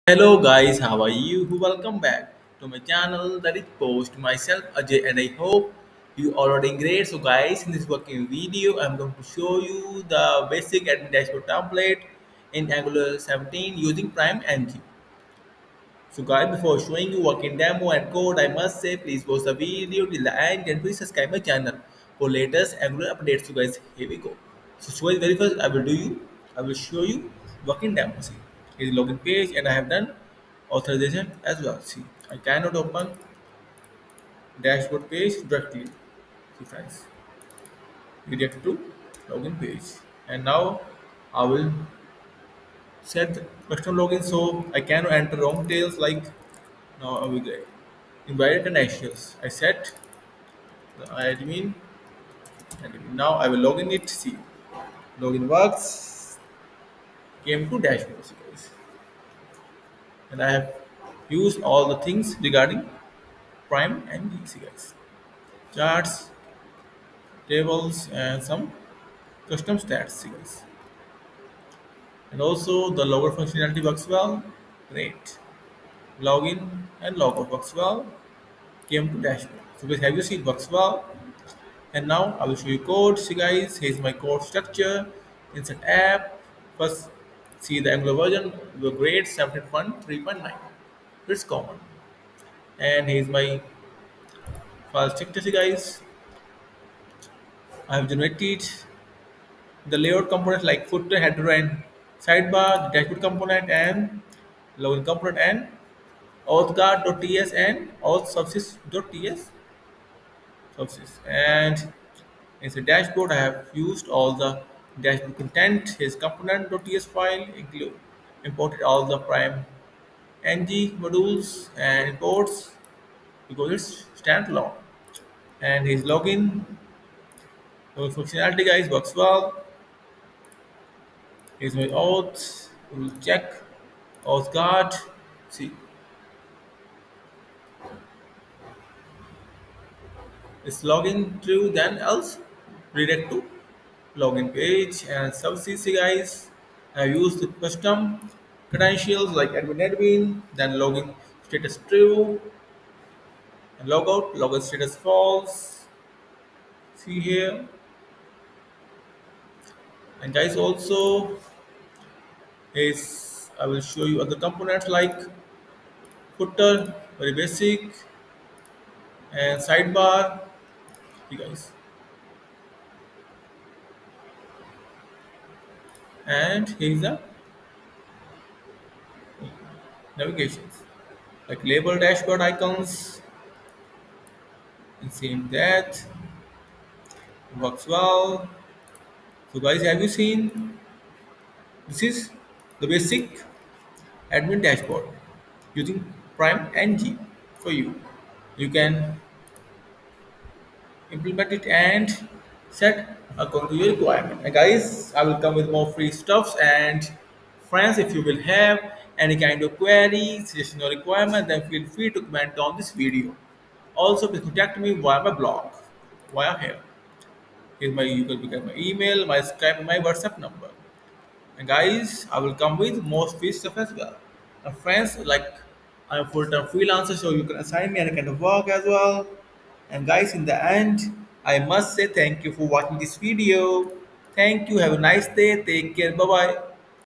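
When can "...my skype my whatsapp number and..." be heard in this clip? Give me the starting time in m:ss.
3:39.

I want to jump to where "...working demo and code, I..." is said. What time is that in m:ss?
0:17.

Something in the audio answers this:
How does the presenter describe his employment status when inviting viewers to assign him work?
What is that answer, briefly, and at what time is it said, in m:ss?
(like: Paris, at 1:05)
full-time freelancer, at 3:46.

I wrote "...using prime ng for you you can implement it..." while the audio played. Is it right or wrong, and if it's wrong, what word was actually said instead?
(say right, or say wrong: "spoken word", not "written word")
right.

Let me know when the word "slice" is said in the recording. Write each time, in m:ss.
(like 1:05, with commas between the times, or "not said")
not said.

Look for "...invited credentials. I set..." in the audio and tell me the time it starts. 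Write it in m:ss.
0:48.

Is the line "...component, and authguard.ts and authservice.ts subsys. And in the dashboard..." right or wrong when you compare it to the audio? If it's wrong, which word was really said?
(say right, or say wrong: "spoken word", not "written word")
right.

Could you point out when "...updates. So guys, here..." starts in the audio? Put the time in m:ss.
0:23.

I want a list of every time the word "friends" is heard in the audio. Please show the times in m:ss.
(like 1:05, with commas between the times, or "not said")
0:36, 3:27, 3:44.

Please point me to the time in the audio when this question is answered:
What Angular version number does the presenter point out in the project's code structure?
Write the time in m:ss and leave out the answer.
1:29.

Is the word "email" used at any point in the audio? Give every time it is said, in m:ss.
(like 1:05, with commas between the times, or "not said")
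3:38.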